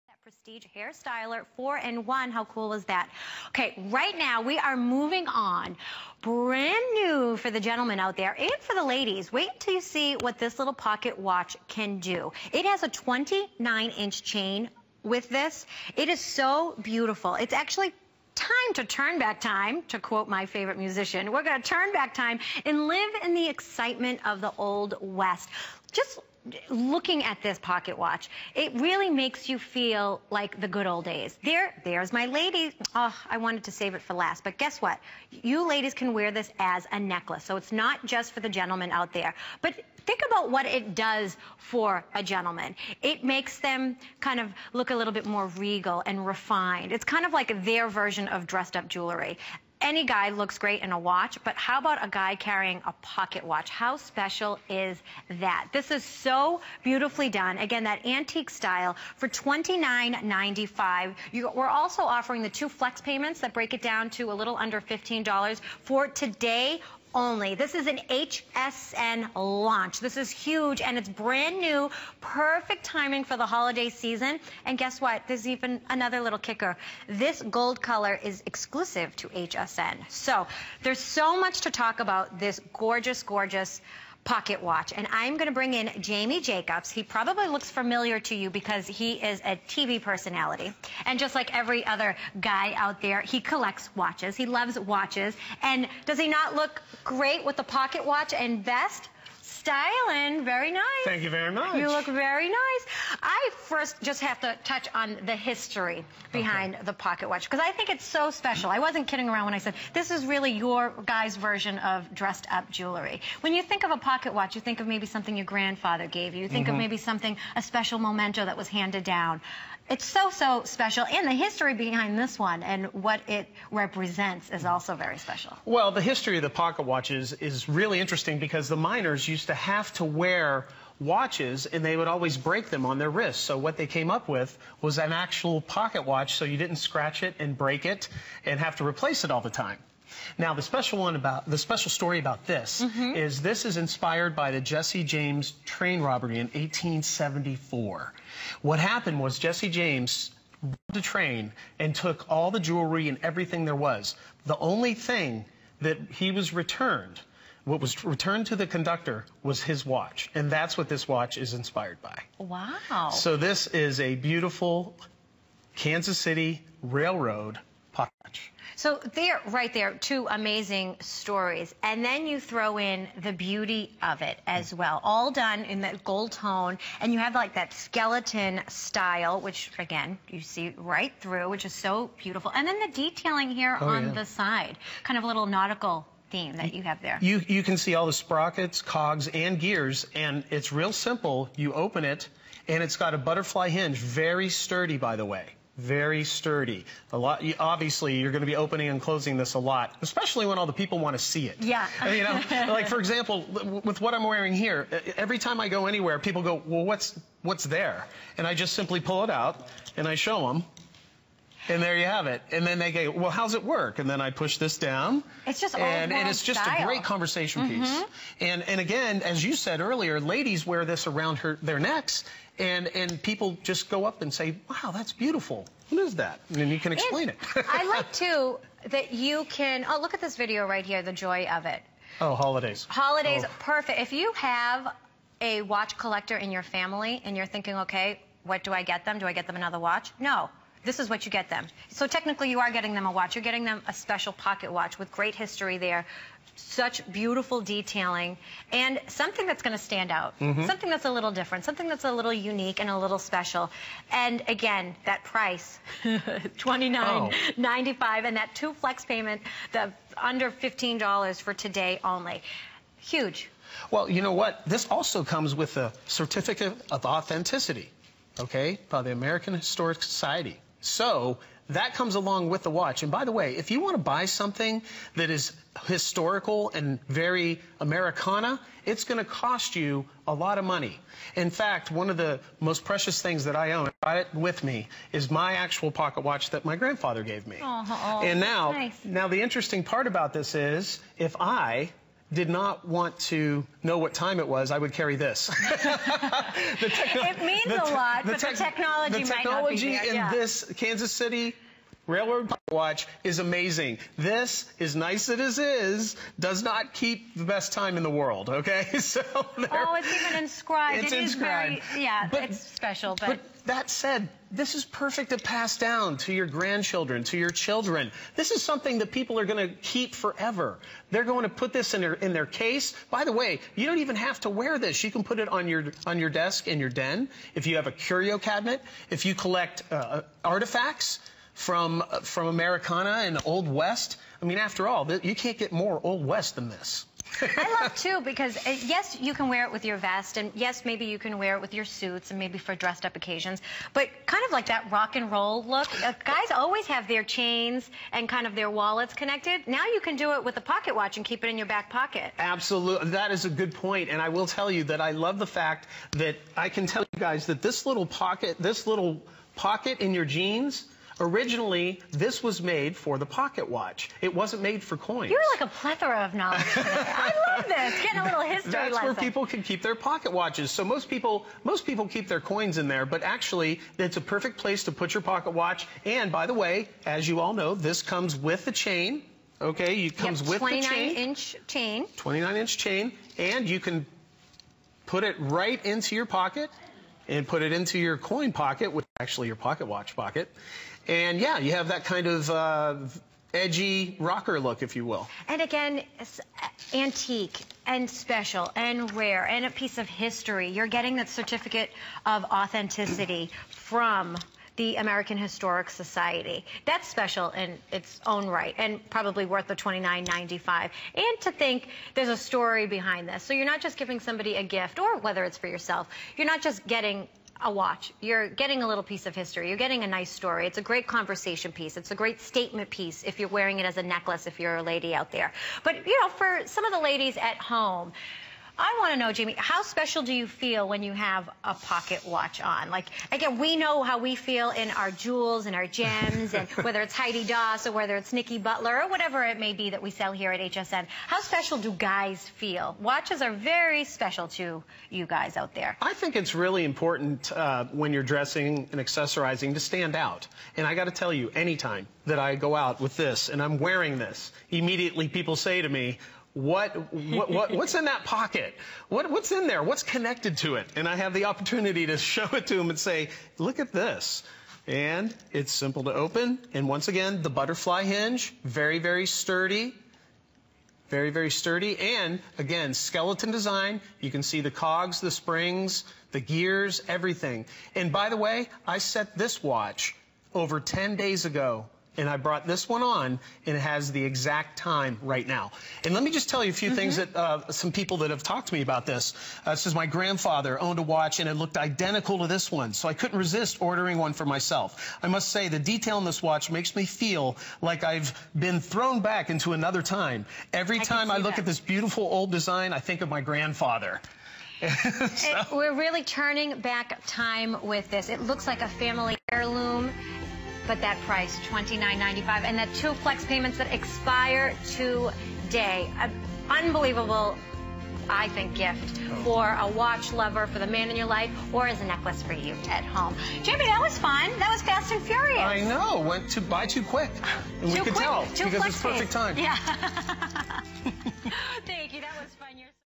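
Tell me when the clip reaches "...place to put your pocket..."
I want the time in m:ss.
6:14.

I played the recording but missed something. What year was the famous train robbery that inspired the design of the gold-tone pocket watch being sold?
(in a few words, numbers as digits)
1874.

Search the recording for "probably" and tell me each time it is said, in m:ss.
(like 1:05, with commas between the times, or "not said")
1:27, 6:49.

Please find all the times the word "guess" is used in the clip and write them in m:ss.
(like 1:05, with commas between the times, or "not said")
0:34, 1:14.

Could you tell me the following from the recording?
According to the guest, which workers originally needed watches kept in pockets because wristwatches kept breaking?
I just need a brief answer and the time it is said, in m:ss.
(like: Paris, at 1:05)
miners, at 2:08.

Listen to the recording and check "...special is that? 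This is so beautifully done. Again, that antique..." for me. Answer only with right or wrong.
right.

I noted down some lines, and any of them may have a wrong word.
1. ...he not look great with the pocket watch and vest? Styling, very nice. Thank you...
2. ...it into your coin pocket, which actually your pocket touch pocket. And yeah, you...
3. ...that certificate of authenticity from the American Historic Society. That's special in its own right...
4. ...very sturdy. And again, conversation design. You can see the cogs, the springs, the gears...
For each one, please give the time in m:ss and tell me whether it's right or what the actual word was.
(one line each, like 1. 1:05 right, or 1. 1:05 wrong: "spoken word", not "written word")
1. 1:36 right
2. 6:27 wrong: "watch", not "touch"
3. 6:41 right
4. 7:51 wrong: "skeleton", not "conversation".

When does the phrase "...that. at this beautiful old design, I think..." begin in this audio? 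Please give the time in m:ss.
8:21.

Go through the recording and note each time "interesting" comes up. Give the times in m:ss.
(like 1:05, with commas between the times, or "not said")
2:07, 4:49.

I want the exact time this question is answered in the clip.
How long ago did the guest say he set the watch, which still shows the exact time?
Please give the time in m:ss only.
8:00.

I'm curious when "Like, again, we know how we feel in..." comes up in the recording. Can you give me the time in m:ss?
7:12.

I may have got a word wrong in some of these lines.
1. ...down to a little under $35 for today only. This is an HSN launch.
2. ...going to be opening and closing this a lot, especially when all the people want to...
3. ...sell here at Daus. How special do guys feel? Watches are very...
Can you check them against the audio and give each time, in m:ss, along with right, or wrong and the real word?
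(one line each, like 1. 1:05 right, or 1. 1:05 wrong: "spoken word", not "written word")
1. 1:03 wrong: "15", not "35"
2. 3:18 right
3. 7:20 wrong: "HSN", not "Daus".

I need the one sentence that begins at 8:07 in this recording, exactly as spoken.
that uh, some people that have talked to me about this.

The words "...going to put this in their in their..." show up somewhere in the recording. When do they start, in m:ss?
5:21.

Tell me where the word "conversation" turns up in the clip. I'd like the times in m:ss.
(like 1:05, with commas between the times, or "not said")
3:37, 7:01.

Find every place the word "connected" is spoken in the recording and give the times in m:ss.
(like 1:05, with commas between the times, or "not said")
5:49, 7:40.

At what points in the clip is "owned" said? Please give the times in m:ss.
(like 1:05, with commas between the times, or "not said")
8:10.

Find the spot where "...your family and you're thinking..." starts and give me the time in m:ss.
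3:56.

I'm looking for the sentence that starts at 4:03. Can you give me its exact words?
You're getting them a special pocket watch with great history there.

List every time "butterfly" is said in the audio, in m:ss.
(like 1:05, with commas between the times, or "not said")
3:13, 7:47.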